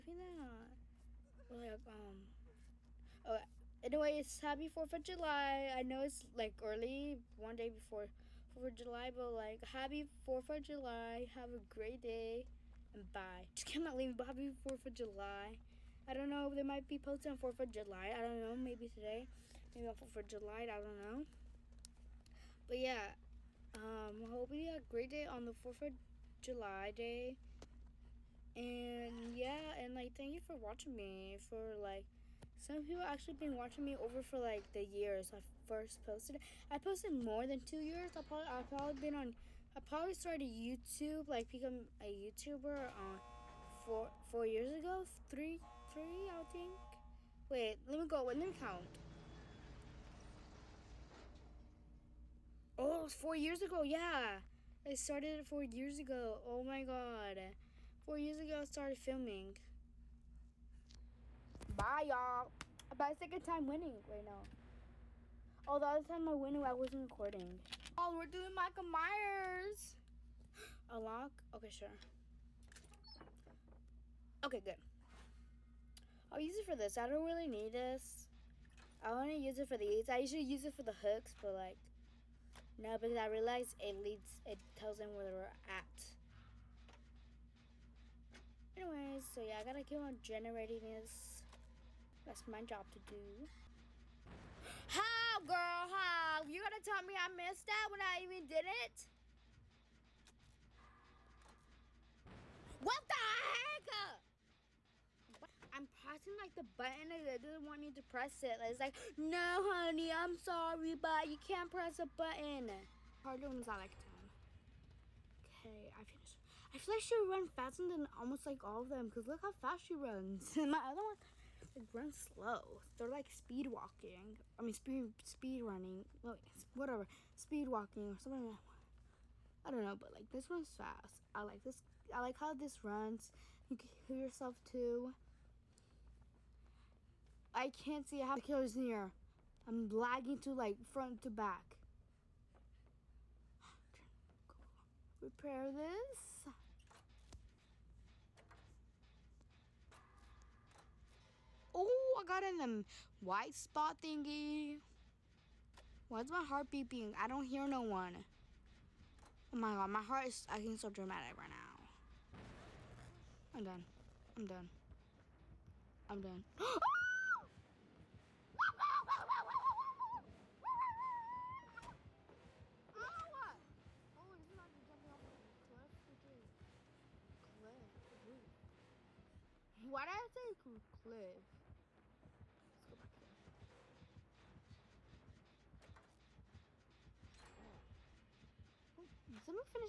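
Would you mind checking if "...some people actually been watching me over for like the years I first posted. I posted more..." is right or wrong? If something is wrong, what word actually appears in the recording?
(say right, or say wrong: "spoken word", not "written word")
right.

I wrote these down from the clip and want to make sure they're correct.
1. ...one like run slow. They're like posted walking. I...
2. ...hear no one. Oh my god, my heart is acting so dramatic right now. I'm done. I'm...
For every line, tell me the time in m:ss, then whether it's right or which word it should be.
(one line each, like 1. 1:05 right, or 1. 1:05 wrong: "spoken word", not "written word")
1. 2:01 wrong: "speed", not "posted"
2. 2:37 right.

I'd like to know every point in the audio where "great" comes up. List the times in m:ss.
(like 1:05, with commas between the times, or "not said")
0:11, 0:24.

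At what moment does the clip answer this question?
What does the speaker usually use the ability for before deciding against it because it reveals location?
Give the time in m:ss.
1:20.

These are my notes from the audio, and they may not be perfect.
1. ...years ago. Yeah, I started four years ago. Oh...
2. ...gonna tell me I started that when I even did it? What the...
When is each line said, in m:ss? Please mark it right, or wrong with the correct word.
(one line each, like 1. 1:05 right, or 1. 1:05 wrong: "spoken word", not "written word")
1. 0:53 right
2. 1:36 wrong: "missed", not "started".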